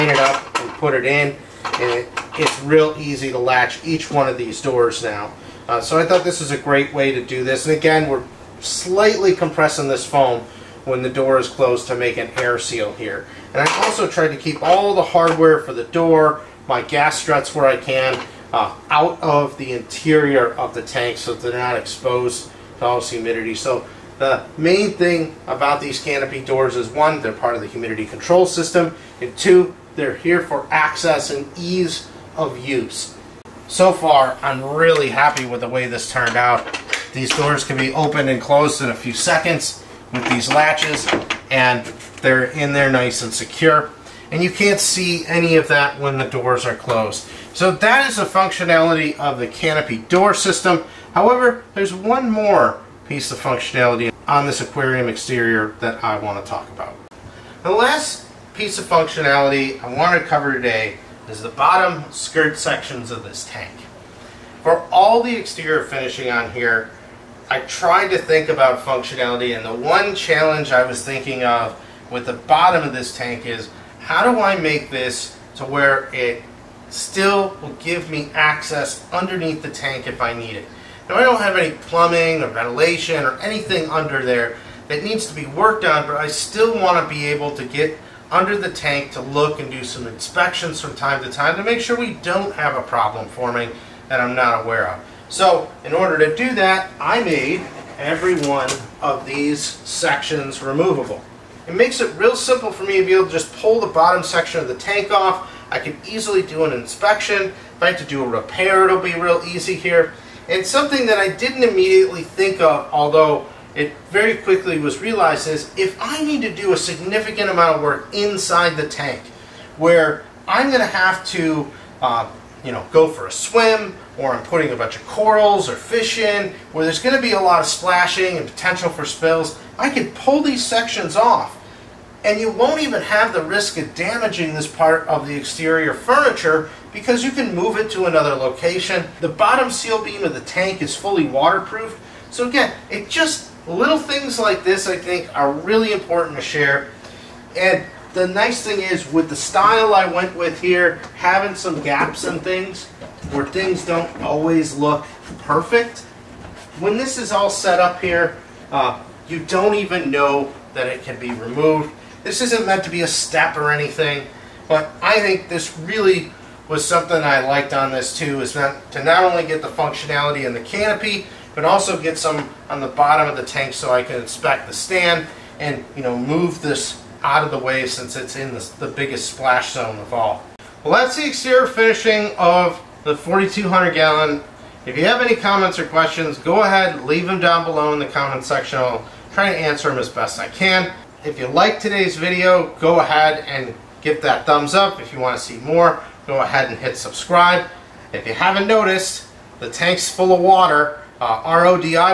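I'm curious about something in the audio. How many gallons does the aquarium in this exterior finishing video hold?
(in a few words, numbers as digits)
4200.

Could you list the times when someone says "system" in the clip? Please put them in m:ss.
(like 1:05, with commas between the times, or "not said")
0:28, 0:50.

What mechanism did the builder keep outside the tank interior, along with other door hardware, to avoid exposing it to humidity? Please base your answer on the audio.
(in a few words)
Gas struts.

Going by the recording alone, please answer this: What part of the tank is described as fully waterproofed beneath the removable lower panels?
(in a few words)
Bottom seal beam.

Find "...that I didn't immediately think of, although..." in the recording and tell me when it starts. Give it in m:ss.
1:51.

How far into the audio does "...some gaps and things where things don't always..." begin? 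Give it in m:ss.
2:31.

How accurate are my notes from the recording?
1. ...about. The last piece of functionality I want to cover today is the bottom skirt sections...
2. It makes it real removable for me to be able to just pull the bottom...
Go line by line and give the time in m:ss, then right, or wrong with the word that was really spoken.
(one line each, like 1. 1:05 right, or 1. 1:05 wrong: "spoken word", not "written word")
1. 0:56 right
2. 1:41 wrong: "simple", not "removable".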